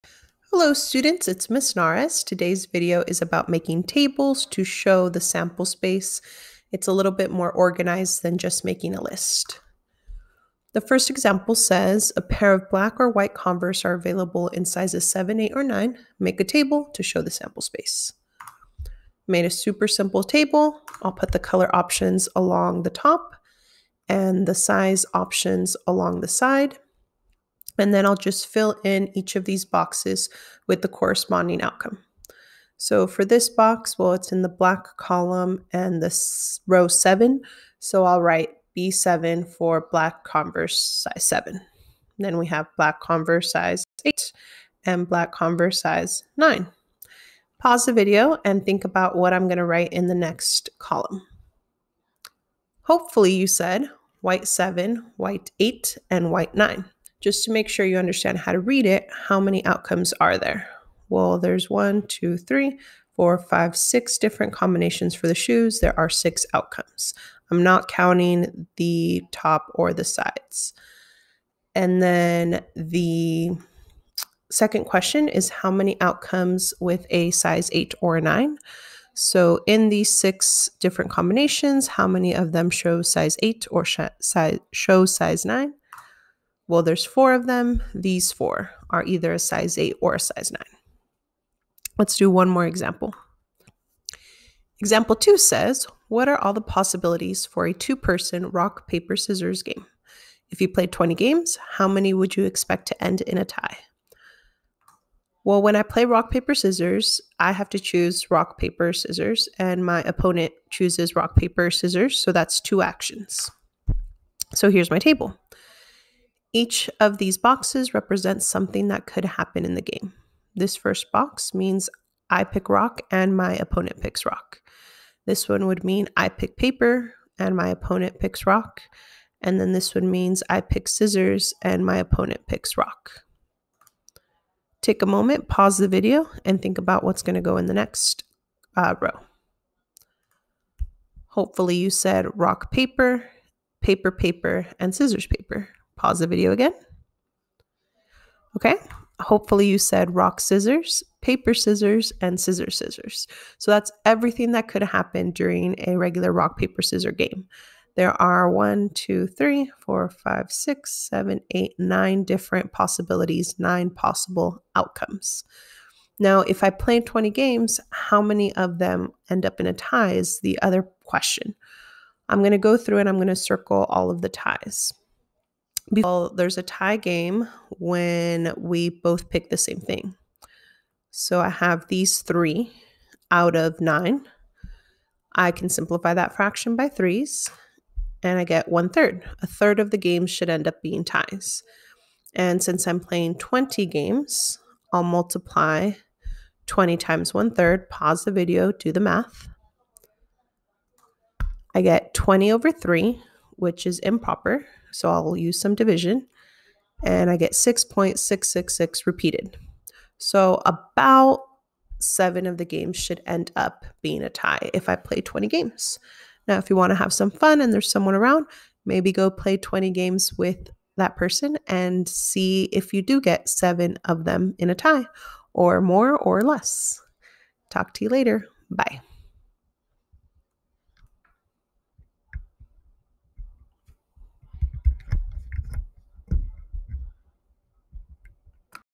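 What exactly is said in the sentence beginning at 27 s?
And then I'll just fill in each of these boxes with the corresponding outcome.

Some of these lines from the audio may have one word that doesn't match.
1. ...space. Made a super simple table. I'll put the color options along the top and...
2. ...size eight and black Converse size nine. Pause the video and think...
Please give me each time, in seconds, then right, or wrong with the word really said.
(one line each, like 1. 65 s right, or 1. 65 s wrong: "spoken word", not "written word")
1. 17 s right
2. 43 s right.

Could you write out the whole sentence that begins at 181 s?
So I have these three out of nine.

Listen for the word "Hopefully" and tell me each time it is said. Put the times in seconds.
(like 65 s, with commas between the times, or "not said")
52 s, 141 s, 149 s.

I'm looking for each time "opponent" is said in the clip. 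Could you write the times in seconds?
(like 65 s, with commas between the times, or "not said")
110 s, 123 s, 127 s, 131 s.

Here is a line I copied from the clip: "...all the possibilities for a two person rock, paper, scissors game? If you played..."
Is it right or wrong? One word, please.
right.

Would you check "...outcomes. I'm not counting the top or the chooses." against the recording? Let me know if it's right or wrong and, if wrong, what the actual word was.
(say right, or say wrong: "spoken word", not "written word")
wrong: "sides", not "chooses".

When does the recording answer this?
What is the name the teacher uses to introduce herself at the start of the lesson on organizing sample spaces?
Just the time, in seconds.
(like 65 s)
1 s.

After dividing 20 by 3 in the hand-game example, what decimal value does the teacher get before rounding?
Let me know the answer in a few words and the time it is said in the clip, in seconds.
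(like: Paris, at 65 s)
6.666 repeated, at 207 s.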